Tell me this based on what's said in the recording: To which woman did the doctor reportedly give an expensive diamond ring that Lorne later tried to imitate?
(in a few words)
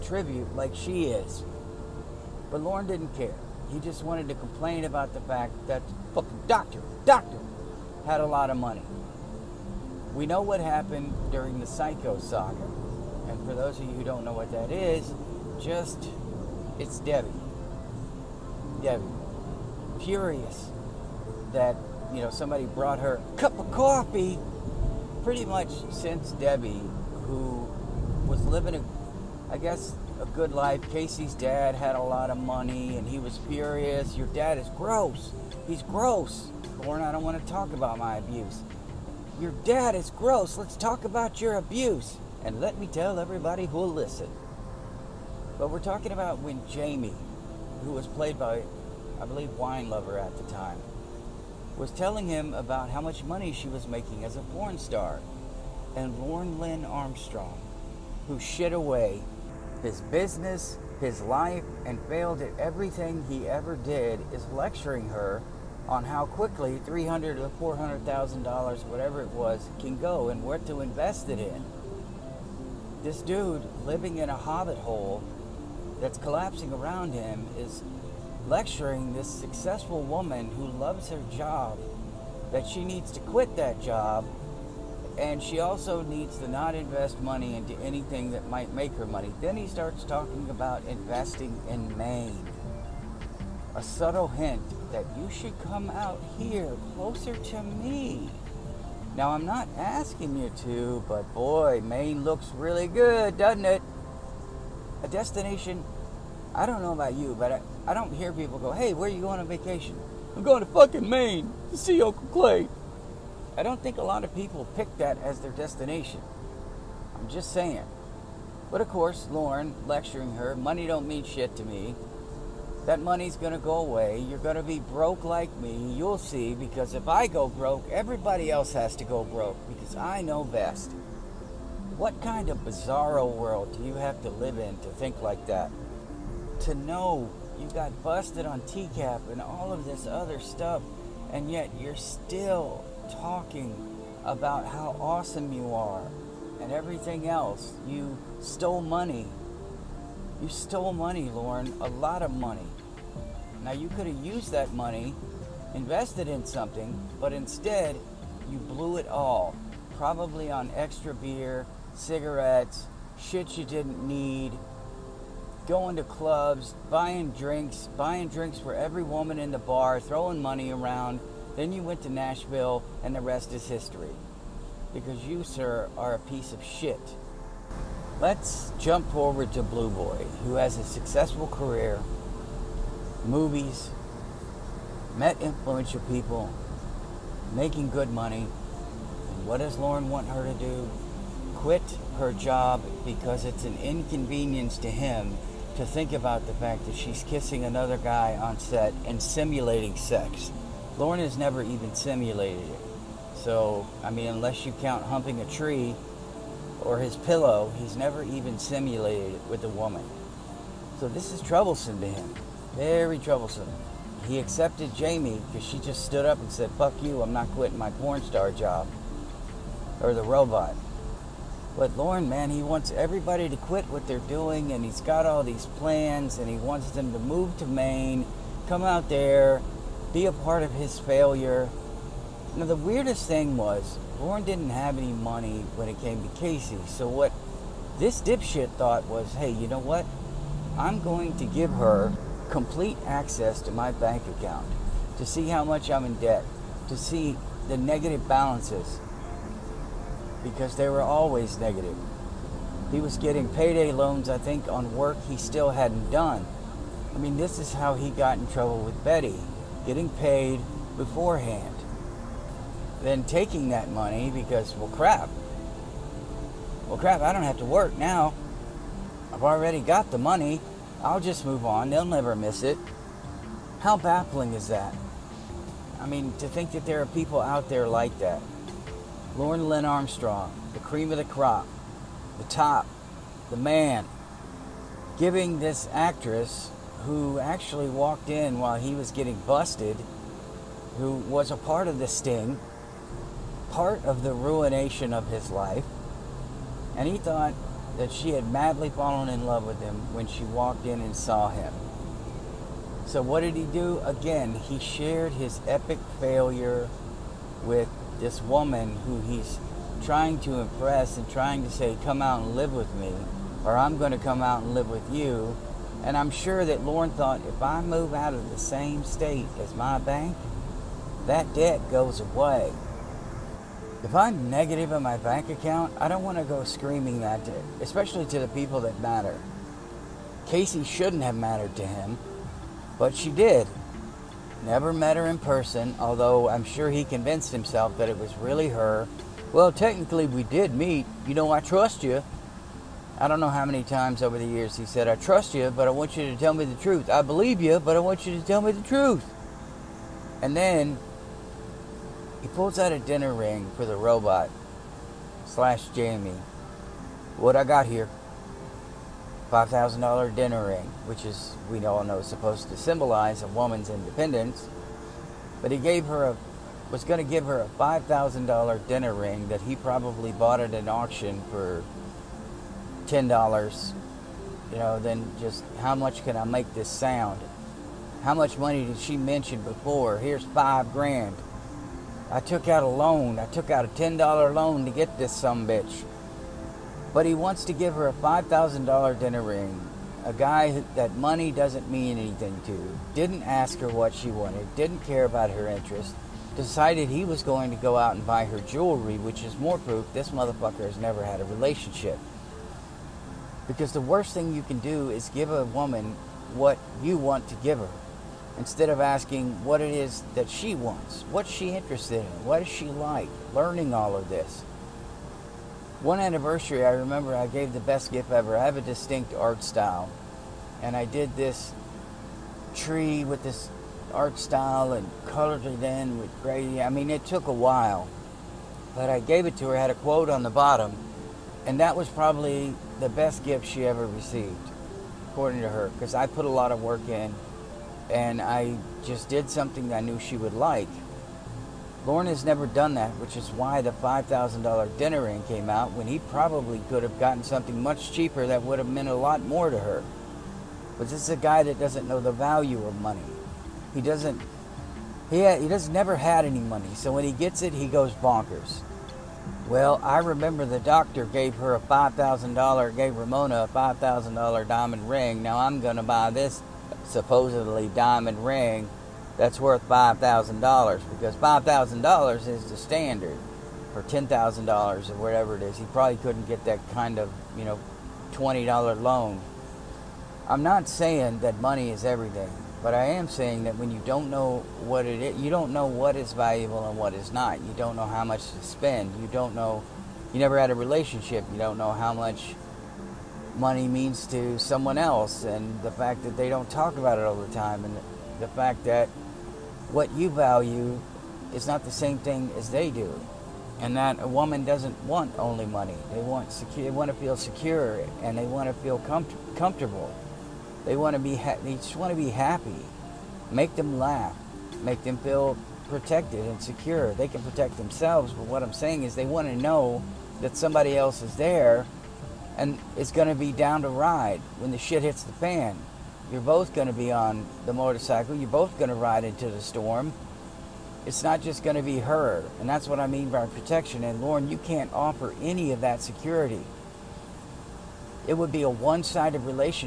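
Ramona.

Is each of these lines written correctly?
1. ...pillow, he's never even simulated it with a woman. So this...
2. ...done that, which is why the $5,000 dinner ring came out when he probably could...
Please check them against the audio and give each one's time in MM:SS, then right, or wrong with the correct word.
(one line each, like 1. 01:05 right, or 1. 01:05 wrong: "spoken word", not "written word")
1. 03:27 right
2. 07:22 right.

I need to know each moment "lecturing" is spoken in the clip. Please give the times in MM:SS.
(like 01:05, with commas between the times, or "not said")
01:04, 01:18, 01:59.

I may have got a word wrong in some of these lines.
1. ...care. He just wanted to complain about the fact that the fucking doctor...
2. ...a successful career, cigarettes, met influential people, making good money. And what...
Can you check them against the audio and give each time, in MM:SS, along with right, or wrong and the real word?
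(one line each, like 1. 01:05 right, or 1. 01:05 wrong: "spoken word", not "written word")
1. 00:03 right
2. 03:00 wrong: "movies", not "cigarettes".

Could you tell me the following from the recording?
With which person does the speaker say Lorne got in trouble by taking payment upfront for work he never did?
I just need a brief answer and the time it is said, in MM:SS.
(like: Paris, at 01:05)
Betty, at 04:19.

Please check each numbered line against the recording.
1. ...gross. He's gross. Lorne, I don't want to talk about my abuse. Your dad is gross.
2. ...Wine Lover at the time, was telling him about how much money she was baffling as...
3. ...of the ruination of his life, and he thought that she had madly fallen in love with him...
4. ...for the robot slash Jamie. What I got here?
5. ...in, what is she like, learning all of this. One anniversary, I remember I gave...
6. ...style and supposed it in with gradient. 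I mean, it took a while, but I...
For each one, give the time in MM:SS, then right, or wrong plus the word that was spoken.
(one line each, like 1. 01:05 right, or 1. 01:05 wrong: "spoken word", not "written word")
1. 00:34 right
2. 00:49 wrong: "making", not "baffling"
3. 04:54 right
4. 05:53 right
5. 06:52 right
6. 07:04 wrong: "colored", not "supposed".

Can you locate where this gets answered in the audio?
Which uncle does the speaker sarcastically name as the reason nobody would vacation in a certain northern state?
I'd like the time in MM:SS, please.
01:52.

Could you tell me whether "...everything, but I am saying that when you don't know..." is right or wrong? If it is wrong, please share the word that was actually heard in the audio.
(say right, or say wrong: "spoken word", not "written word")
right.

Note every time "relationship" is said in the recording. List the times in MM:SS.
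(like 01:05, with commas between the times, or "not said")
06:41, 08:10.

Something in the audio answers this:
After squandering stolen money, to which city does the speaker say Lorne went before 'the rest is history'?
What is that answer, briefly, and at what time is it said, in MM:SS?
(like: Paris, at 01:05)
Nashville, at 02:52.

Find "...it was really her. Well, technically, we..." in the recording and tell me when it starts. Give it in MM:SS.
05:38.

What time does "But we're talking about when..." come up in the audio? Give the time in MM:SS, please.
00:45.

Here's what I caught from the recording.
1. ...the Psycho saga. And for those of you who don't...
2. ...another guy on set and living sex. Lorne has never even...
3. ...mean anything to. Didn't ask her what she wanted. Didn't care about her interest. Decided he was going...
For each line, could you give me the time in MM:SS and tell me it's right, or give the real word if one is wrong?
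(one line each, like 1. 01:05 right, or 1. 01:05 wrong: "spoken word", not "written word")
1. 00:11 right
2. 03:17 wrong: "simulating", not "living"
3. 06:31 right.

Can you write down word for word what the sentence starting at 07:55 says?
He probably couldn't get that kind of, you know, $20 loan.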